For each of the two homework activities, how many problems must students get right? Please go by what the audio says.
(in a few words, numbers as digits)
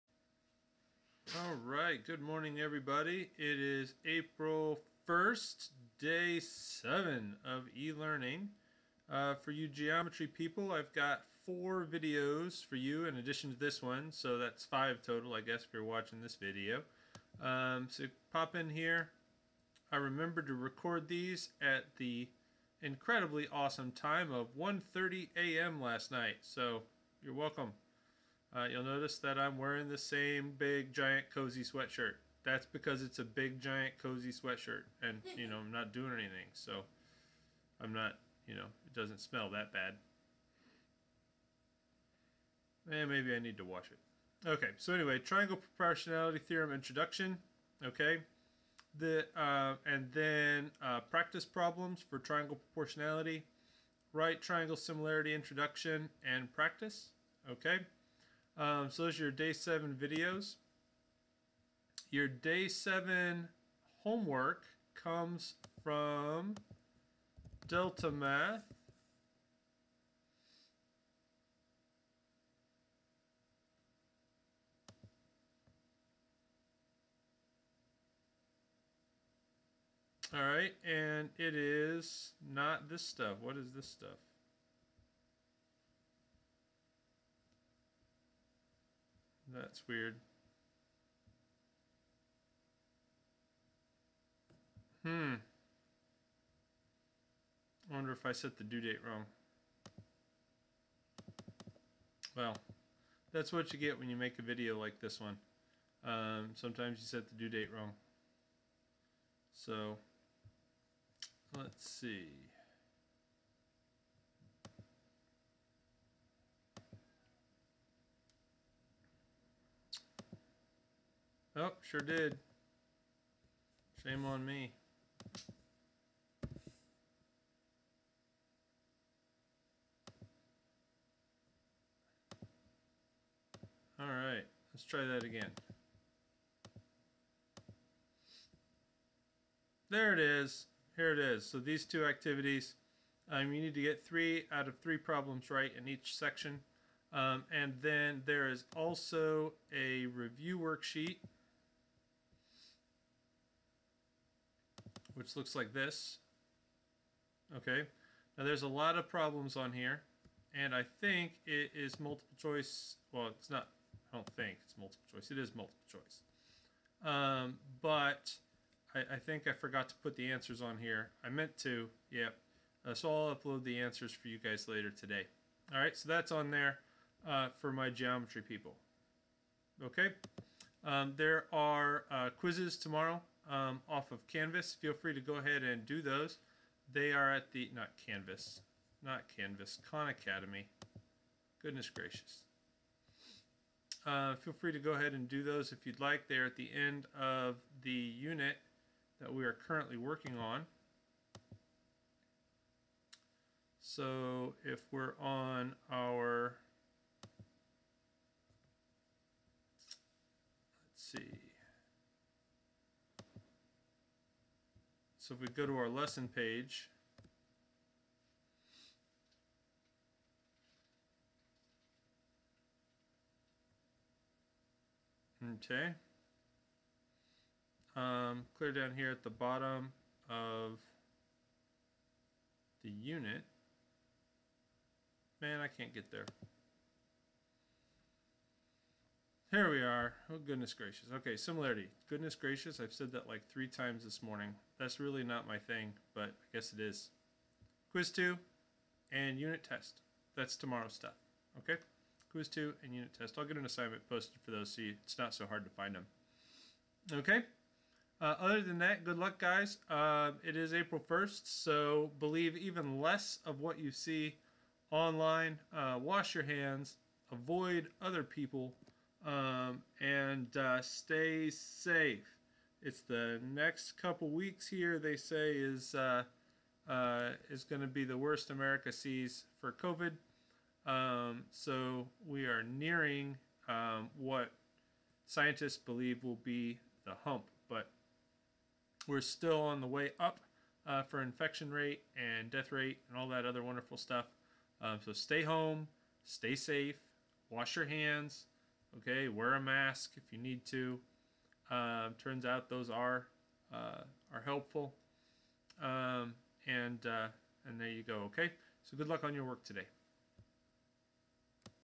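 3 out of 3.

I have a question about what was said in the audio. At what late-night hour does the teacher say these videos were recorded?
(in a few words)
1:30 a.m.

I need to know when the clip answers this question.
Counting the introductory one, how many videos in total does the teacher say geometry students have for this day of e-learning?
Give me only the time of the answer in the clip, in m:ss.
0:14.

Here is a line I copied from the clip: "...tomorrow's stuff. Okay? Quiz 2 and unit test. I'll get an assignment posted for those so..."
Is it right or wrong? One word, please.
right.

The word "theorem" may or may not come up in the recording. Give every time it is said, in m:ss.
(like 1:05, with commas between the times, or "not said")
0:46.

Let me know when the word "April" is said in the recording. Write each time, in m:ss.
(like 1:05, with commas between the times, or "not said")
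0:04, 4:20.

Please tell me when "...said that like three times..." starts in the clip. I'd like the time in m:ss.
4:02.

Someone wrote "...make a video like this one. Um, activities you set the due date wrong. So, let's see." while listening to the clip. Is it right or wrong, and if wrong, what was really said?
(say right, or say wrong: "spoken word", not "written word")
wrong: "sometimes", not "activities".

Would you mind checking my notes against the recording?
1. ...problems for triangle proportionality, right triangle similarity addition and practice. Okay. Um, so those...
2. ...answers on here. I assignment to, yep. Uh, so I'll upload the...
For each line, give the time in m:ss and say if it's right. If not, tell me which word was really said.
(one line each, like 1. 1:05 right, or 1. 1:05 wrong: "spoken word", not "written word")
1. 0:51 wrong: "introduction", not "addition"
2. 2:50 wrong: "meant", not "assignment".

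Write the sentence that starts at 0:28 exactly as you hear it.
Uh, you'll notice that I'm wearing the same big giant cozy sweatshirt.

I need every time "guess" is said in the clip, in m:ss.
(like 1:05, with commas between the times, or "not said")
0:15, 4:06.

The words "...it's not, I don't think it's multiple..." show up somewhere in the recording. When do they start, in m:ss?
2:43.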